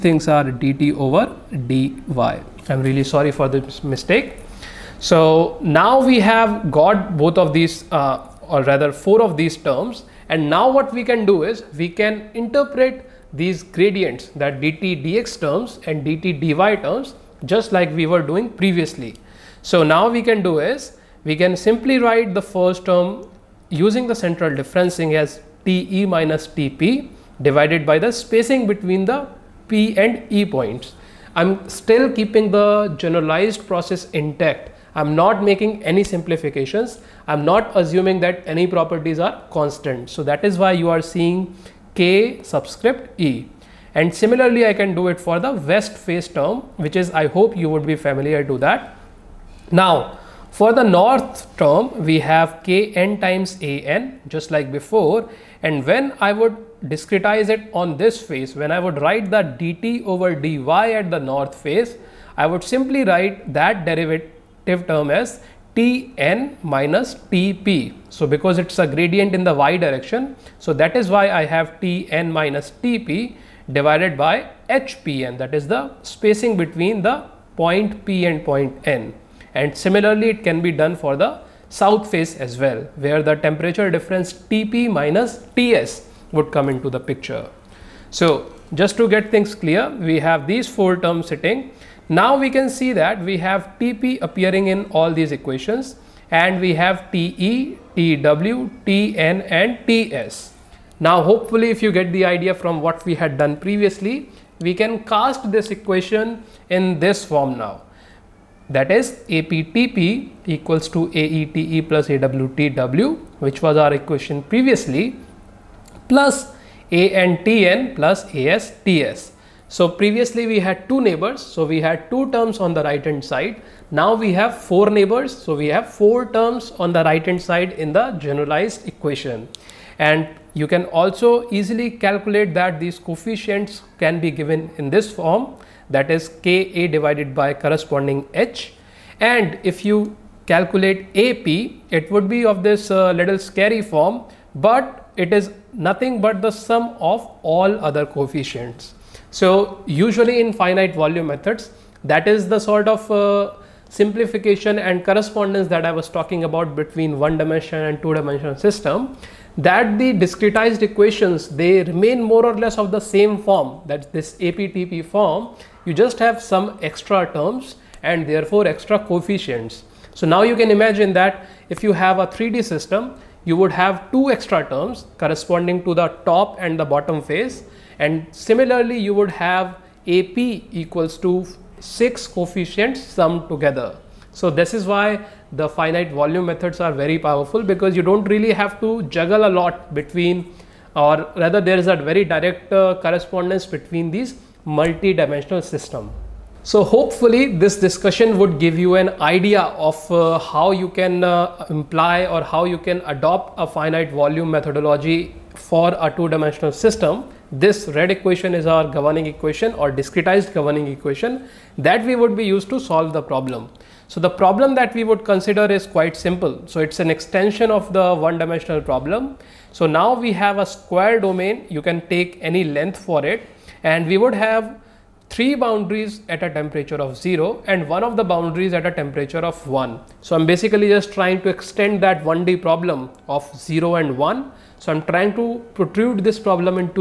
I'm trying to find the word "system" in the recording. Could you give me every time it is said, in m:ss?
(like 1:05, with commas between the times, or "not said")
2:38, 2:52, 3:15, 3:26.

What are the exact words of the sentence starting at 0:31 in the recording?
I'm still keeping the generalized process intact I'm not making any simplifications.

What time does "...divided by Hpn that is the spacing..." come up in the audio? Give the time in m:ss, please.
1:13.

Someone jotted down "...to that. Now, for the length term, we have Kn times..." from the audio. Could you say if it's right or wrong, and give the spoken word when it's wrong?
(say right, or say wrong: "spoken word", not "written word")
wrong: "north", not "length".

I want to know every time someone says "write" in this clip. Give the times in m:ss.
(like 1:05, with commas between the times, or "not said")
0:21, 0:59, 1:03.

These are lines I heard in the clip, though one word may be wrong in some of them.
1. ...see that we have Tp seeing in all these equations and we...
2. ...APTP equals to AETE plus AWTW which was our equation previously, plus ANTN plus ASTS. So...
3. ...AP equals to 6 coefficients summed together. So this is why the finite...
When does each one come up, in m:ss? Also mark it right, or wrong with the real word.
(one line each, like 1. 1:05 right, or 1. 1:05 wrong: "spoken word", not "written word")
1. 1:32 wrong: "appearing", not "seeing"
2. 1:49 right
3. 3:00 right.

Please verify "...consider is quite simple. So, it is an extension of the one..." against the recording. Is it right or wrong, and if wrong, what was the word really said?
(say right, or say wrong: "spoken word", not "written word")
right.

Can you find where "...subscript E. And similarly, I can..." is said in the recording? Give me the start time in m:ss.
0:42.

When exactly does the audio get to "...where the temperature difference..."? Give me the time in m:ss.
1:22.